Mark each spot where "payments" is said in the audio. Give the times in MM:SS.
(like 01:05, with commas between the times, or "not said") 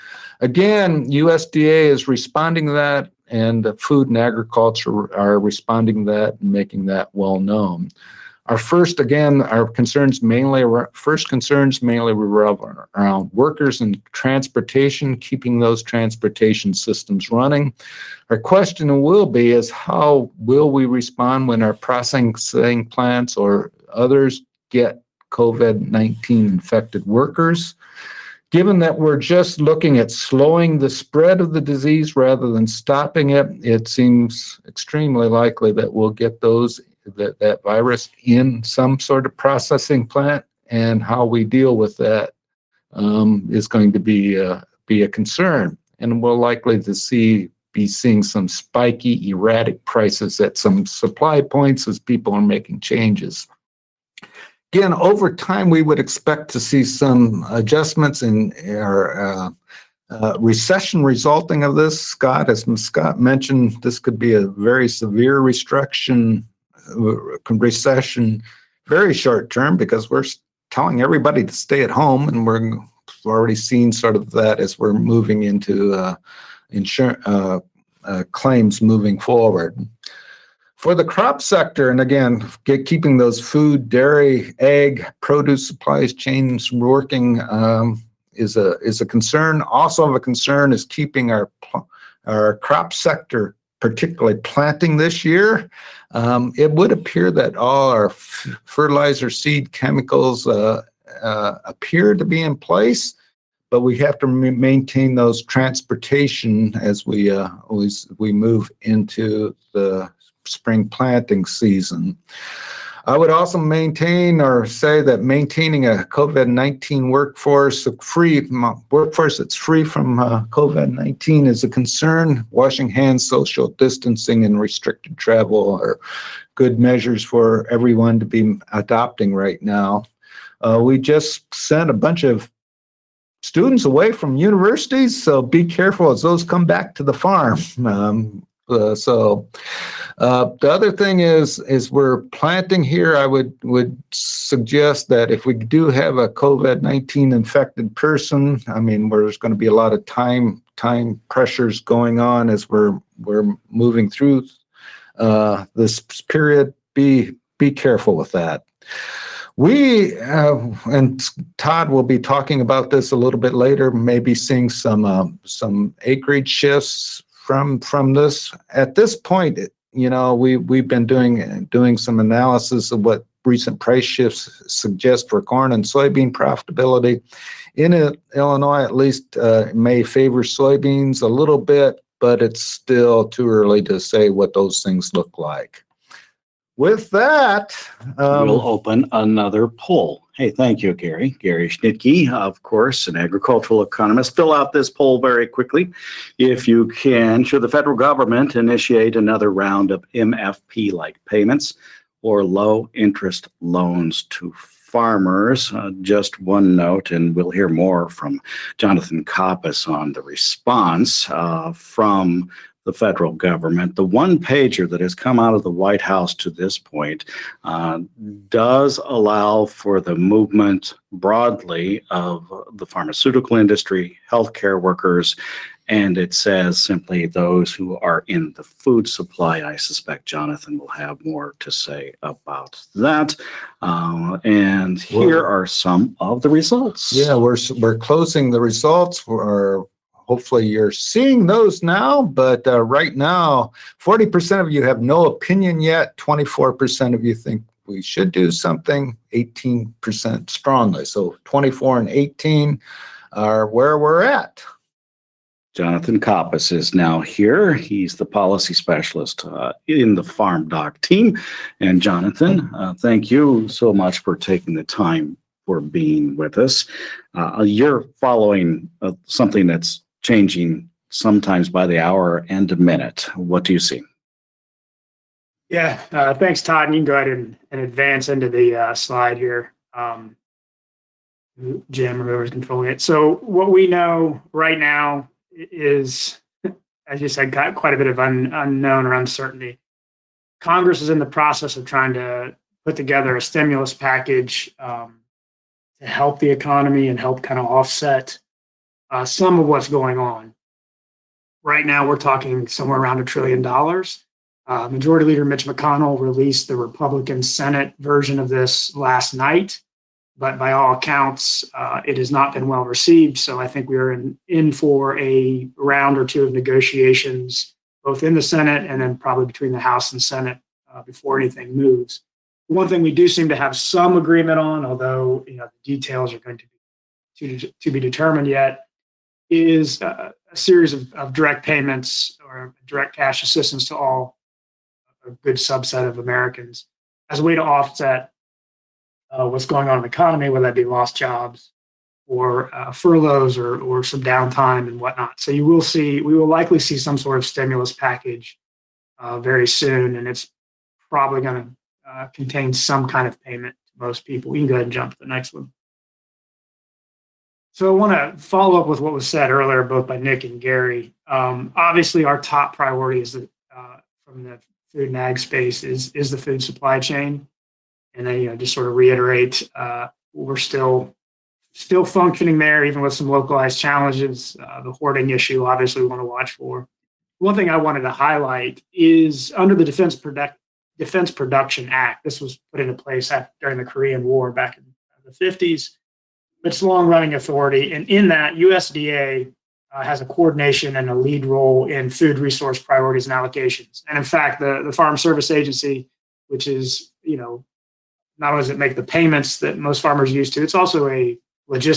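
03:21, 05:31, 05:53, 06:39.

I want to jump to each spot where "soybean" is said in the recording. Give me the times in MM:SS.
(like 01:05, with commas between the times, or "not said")
02:55, 03:00.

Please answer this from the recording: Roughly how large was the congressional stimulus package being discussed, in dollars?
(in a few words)
A trillion dollars.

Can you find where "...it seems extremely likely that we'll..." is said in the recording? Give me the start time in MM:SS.
00:33.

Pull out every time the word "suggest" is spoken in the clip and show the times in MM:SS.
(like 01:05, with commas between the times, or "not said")
02:24, 02:54.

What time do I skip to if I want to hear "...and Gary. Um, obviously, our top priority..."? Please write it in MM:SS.
06:00.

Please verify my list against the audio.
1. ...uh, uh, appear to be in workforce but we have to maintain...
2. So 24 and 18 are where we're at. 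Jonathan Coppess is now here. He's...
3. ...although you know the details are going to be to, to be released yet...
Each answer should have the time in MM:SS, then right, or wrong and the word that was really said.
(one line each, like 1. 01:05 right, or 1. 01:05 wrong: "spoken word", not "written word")
1. 01:40 wrong: "place", not "workforce"
2. 04:11 right
3. 05:24 wrong: "determined", not "released".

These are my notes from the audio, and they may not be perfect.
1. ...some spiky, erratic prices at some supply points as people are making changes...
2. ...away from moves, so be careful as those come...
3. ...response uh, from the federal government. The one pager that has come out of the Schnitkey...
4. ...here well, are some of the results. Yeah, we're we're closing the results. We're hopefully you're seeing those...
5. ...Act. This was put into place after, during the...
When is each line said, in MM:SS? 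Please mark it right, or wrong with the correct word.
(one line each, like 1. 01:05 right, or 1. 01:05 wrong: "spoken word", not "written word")
1. 00:48 right
2. 02:13 wrong: "universities", not "moves"
3. 03:30 wrong: "White", not "Schnitkey"
4. 03:54 right
5. 06:21 right.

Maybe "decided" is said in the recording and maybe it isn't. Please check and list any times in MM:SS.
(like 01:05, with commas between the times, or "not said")
not said.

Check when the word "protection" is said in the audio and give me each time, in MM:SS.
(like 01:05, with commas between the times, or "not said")
not said.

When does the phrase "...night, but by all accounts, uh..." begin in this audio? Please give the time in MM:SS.
05:09.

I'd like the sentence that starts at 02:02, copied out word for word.
Washing hands, social distancing, and restricted travel are good measures for everyone to be adopting right now.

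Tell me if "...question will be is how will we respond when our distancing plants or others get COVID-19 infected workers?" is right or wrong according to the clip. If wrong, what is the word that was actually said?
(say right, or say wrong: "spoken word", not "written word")
wrong: "processing", not "distancing".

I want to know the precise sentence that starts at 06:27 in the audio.
And in that, USDA uh, has a coordination and a lead role in food resource priorities and allocations.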